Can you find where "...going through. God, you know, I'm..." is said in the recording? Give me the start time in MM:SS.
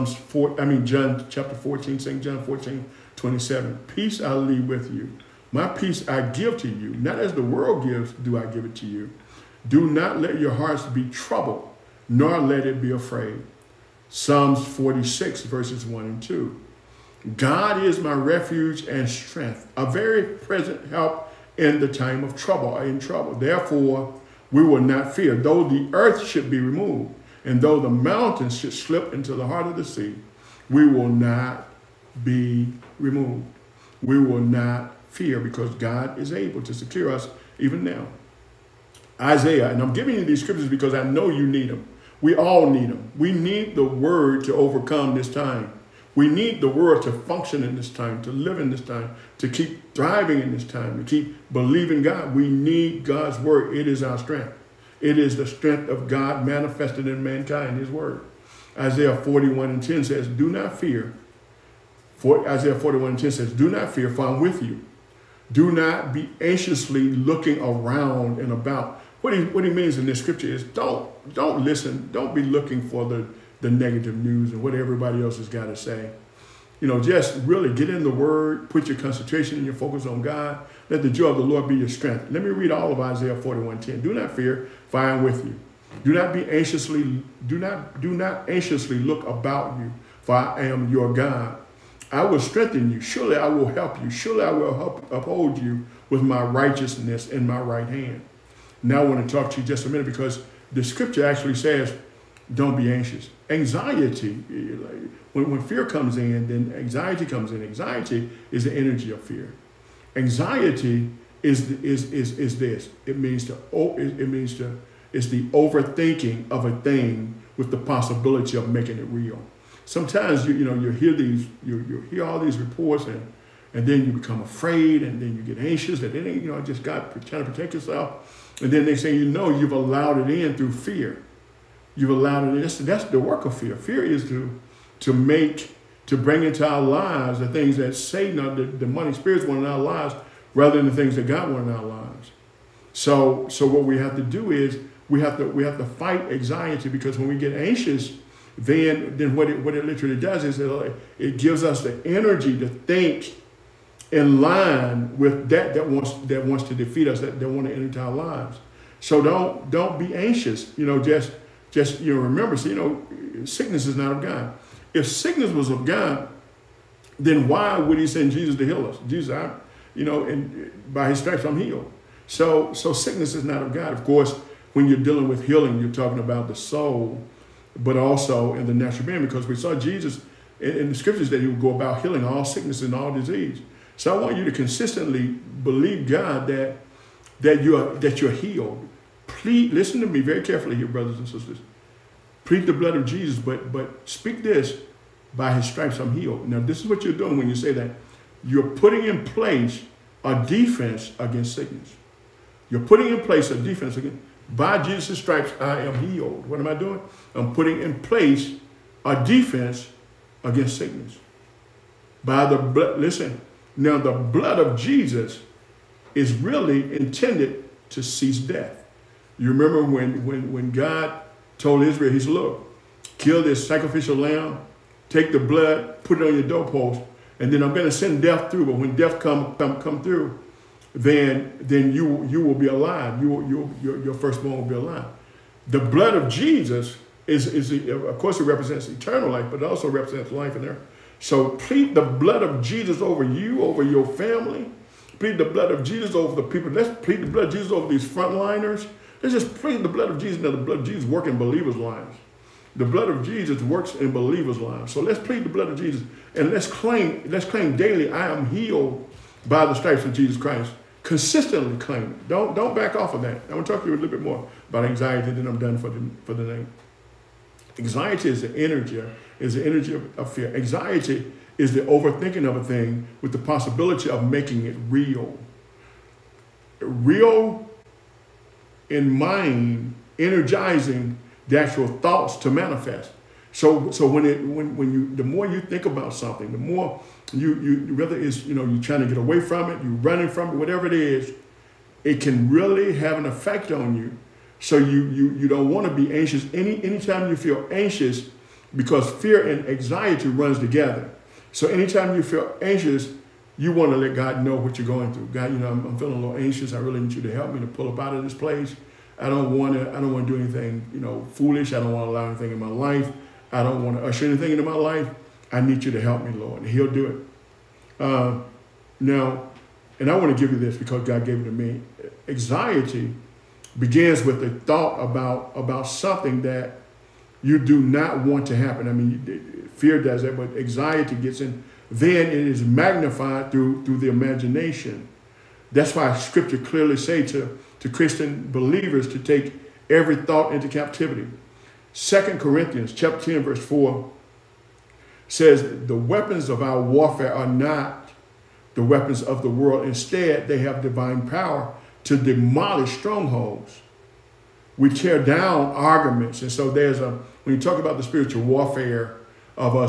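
05:04.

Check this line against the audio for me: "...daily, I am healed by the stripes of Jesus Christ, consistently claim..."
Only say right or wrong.
right.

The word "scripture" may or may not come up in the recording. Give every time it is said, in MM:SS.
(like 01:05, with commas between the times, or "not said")
00:40, 01:10, 01:40, 03:00, 05:36.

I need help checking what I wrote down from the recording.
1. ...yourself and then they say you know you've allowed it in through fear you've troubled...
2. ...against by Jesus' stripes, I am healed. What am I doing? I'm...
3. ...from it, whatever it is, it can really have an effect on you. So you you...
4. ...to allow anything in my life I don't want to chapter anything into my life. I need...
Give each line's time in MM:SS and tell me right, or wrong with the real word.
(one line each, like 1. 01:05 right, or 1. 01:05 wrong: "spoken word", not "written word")
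1. 02:07 wrong: "allowed", not "troubled"
2. 03:23 right
3. 04:50 right
4. 05:12 wrong: "usher", not "chapter".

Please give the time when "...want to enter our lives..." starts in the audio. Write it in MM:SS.
02:37.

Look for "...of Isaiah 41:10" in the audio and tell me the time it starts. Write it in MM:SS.
01:22.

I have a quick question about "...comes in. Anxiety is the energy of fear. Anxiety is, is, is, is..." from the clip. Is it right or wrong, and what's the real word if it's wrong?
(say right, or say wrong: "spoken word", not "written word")
right.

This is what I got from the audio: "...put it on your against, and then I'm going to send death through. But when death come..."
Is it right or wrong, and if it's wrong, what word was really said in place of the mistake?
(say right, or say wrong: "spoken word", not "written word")
wrong: "doorpost", not "against".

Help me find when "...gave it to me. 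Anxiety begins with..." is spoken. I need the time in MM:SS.
05:21.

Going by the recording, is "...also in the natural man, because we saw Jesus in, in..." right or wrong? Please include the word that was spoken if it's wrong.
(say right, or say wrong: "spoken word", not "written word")
right.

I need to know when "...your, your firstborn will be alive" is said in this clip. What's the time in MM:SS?
03:53.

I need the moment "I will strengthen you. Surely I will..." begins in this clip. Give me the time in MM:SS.
01:32.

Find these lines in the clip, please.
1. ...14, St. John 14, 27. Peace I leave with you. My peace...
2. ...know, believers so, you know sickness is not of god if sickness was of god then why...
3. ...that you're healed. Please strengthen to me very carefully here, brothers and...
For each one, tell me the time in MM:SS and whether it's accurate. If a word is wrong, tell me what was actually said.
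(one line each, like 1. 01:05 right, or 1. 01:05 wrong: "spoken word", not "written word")
1. 00:01 right
2. 02:42 wrong: "remember", not "believers"
3. 03:07 wrong: "listen", not "strengthen".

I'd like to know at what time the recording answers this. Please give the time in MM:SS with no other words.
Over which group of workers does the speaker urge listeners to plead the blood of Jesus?
04:08.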